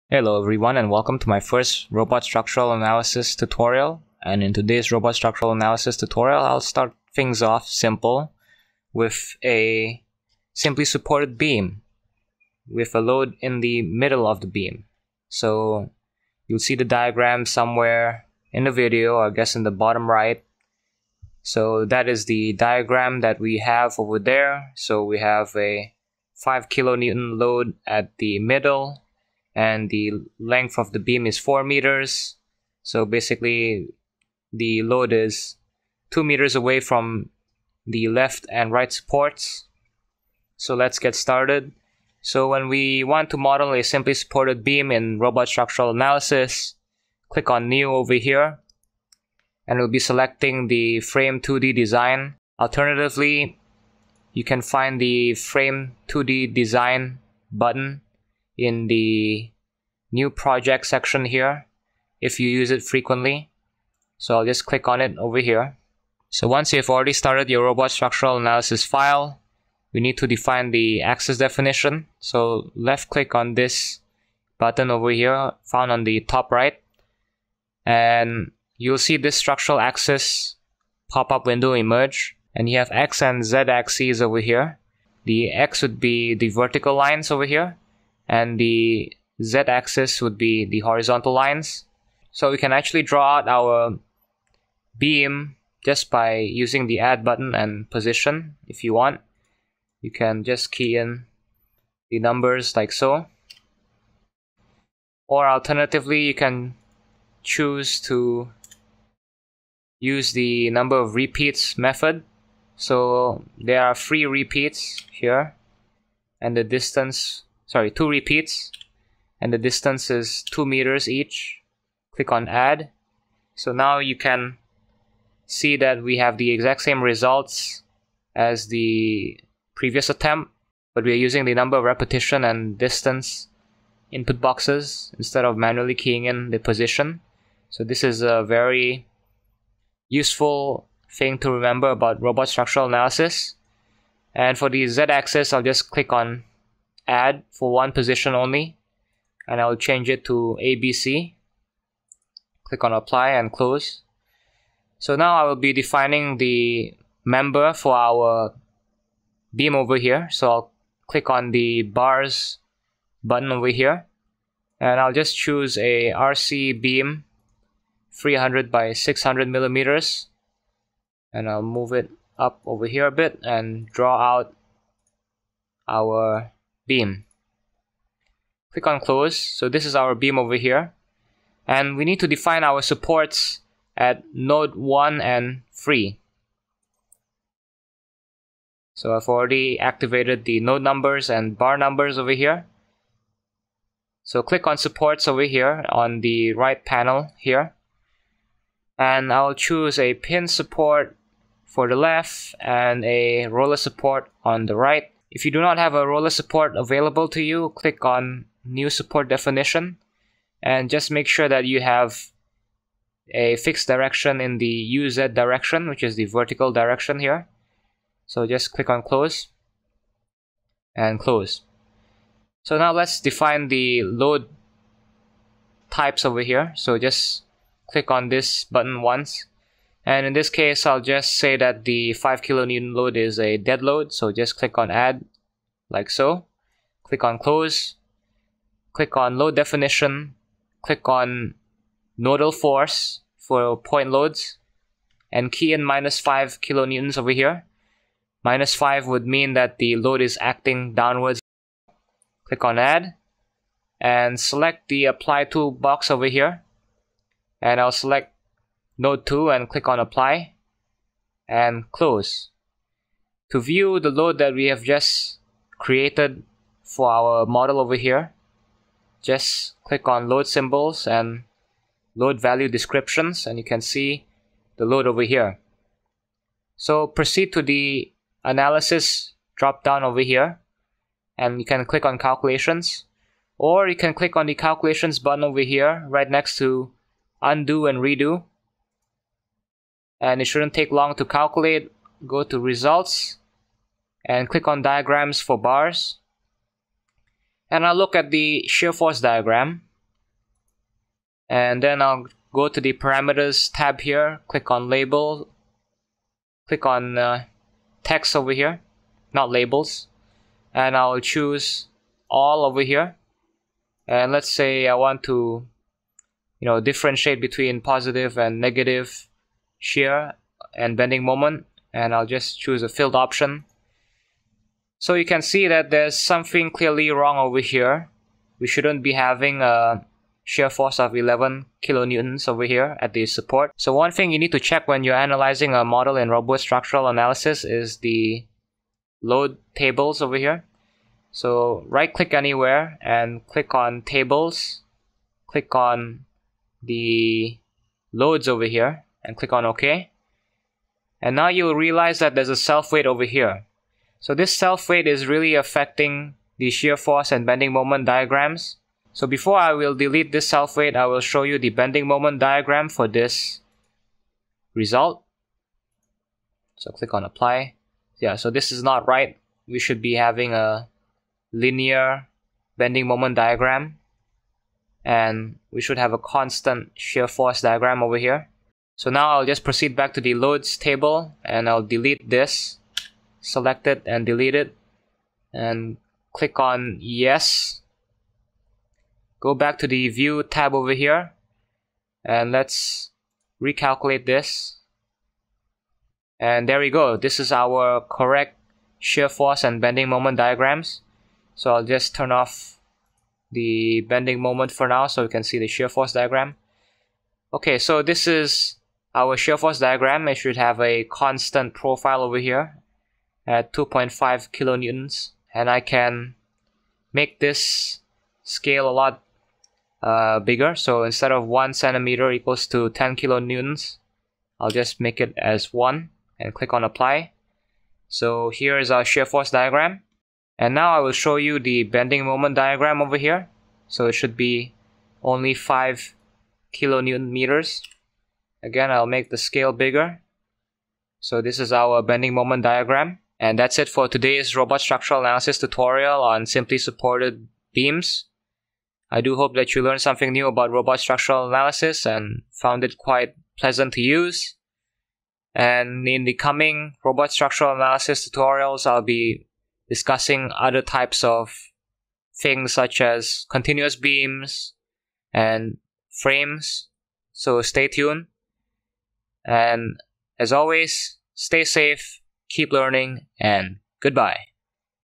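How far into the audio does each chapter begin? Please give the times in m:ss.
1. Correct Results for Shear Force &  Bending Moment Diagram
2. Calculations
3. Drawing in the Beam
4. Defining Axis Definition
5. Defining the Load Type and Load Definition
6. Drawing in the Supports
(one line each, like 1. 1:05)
1. 6:35
2. 4:35
3. 2:35
4. 1:05
5. 3:42
6. 3:14.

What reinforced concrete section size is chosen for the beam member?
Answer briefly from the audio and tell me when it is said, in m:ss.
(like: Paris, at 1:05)
300 by 600 millimeters, at 2:48.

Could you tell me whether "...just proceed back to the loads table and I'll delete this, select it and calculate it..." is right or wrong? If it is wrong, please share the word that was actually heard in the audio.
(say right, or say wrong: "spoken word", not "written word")
wrong: "delete", not "calculate".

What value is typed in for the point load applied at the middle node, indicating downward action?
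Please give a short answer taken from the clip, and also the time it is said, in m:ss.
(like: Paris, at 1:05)
-5 kilonewtons, at 4:05.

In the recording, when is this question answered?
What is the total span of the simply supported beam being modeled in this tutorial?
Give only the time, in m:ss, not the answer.
0:31.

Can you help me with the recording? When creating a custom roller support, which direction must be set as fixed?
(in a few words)
UZ direction.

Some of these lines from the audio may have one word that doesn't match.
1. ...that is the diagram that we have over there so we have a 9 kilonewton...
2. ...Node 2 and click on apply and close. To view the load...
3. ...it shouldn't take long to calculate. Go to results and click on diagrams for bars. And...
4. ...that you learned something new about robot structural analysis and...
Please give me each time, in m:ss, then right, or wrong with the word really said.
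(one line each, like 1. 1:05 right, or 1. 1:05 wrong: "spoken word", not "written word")
1. 0:21 wrong: "5", not "9"
2. 4:18 right
3. 4:50 right
4. 7:29 right.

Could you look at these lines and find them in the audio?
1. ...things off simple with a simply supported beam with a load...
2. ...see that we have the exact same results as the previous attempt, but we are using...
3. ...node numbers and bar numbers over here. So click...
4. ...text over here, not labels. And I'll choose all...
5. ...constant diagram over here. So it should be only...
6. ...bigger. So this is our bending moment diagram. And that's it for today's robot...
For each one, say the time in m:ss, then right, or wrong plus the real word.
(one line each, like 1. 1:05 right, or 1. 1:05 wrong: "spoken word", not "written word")
1. 0:07 right
2. 2:05 right
3. 3:10 right
4. 5:08 right
5. 7:12 wrong: "moment", not "constant"
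6. 7:19 right.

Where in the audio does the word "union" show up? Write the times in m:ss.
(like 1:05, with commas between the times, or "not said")
not said.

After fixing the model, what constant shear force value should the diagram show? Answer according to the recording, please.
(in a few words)
2.5 kilonewtons.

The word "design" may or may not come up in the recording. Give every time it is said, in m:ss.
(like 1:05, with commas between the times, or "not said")
0:51, 0:56.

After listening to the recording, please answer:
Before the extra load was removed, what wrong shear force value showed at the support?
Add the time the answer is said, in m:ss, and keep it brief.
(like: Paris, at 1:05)
11 kilonewtons, at 5:31.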